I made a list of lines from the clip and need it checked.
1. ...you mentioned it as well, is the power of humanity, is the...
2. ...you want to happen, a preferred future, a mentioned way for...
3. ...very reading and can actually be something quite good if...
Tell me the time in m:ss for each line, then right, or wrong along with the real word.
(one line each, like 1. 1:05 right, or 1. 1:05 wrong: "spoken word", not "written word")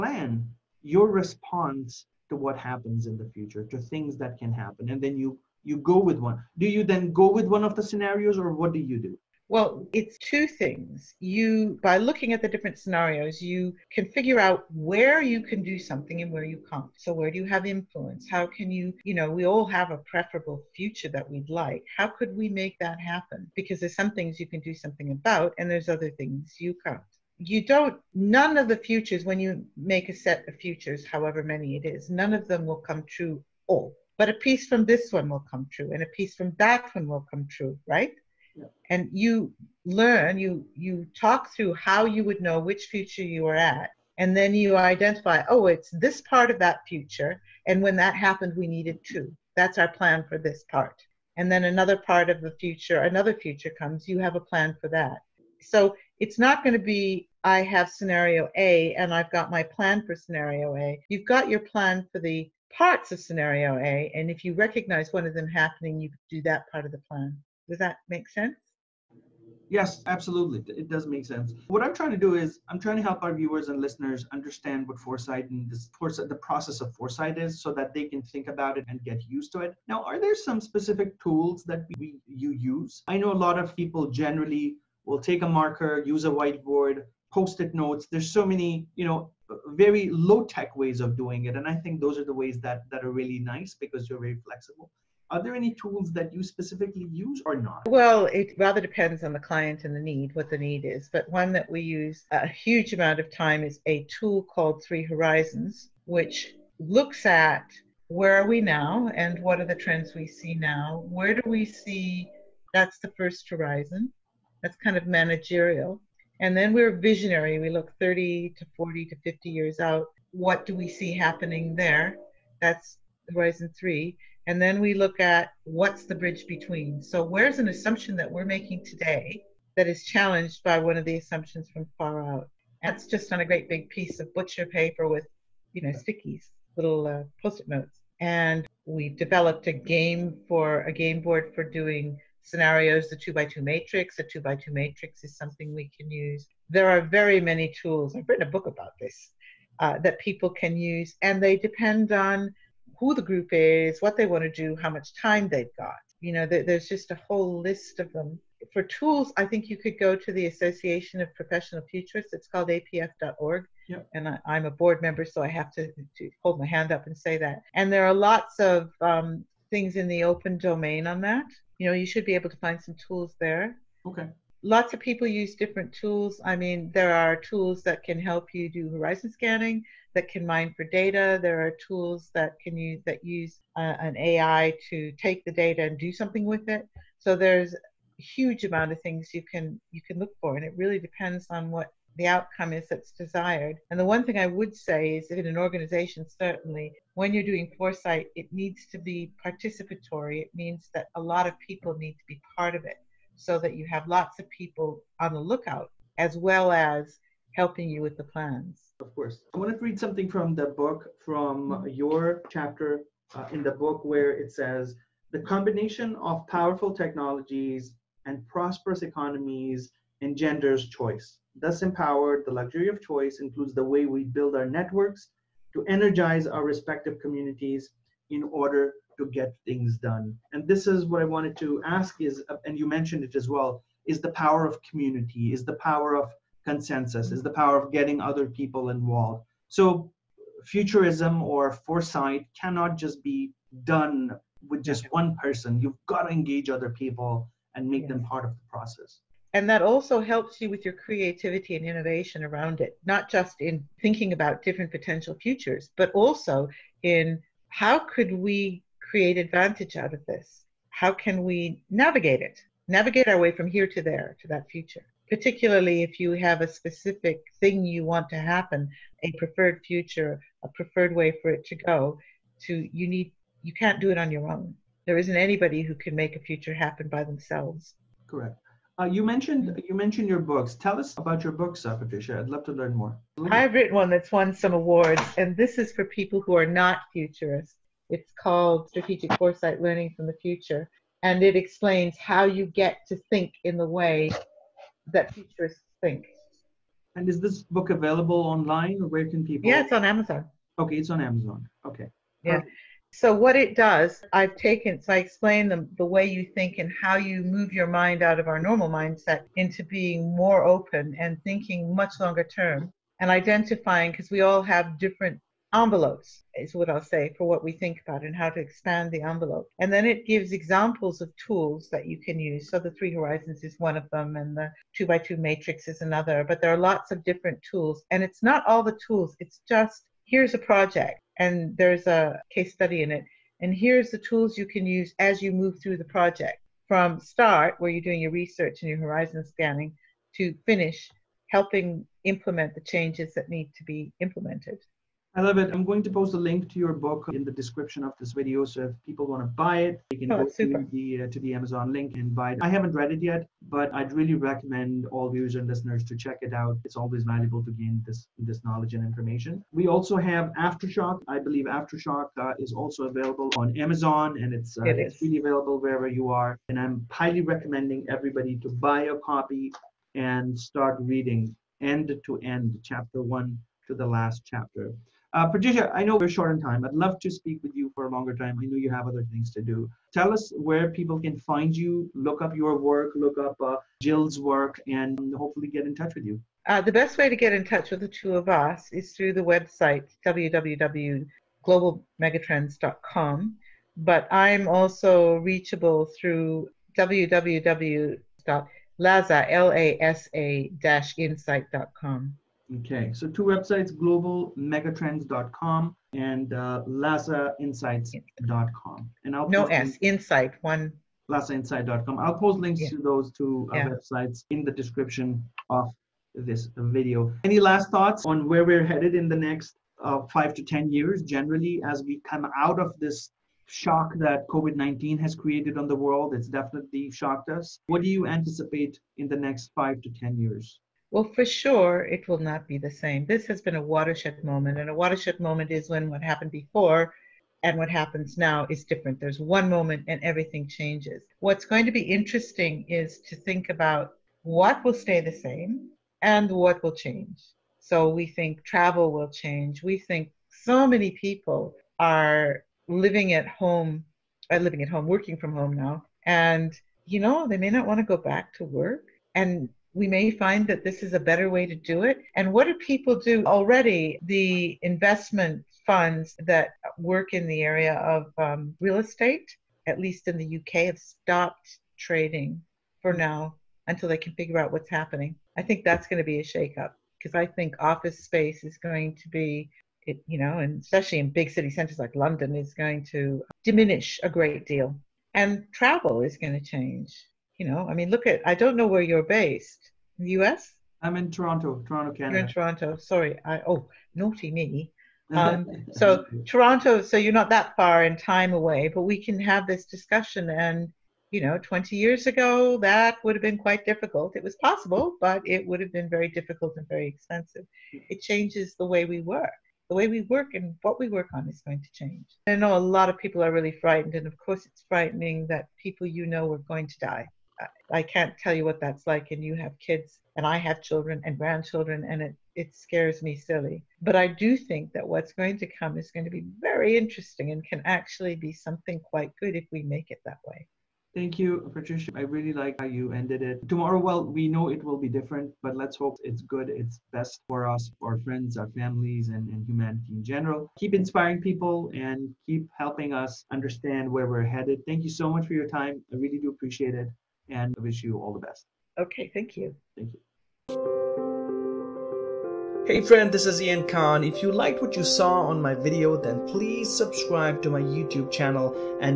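1. 3:52 wrong: "community", not "humanity"
2. 4:27 wrong: "preferred", not "mentioned"
3. 8:46 wrong: "interesting", not "reading".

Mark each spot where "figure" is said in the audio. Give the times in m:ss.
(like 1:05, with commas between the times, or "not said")
0:14, 7:54.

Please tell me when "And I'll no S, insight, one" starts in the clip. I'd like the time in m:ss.
6:49.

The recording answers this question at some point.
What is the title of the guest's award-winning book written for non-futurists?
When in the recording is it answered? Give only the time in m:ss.
4:48.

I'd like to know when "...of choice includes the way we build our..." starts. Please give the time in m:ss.
3:42.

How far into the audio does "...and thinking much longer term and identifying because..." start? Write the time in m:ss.
5:11.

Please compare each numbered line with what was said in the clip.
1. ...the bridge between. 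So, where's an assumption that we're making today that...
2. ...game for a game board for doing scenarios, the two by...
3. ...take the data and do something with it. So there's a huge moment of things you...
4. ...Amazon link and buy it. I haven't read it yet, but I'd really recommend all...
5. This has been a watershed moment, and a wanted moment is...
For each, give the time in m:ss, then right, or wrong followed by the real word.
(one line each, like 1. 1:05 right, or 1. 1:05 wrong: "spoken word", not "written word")
1. 2:06 right
2. 2:19 right
3. 3:05 wrong: "amount", not "moment"
4. 5:51 right
5. 7:13 wrong: "watershed", not "wanted".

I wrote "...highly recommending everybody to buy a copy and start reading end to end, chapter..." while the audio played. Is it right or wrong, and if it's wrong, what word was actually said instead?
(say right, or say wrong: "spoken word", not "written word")
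right.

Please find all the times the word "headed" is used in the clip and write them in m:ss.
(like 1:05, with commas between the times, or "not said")
6:58, 9:04.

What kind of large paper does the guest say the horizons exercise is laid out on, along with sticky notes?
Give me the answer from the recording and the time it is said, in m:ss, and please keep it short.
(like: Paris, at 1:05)
butcher paper, at 2:14.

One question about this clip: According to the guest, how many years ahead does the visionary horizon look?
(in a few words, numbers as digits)
30 to 50 years.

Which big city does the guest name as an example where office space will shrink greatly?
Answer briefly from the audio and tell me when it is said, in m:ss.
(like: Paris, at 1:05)
London, at 8:02.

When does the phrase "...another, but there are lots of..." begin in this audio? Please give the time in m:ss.
5:26.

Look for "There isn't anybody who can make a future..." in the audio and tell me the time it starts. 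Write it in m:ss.
4:35.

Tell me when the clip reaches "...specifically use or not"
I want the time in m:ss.
1:36.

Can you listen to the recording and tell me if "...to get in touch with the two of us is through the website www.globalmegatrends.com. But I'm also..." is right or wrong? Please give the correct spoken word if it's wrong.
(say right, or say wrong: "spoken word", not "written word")
right.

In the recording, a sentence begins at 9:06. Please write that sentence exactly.
I really do appreciate it and wish you all the best.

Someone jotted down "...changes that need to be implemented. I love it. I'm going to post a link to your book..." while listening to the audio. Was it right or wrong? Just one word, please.
right.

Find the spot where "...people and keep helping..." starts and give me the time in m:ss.
9:01.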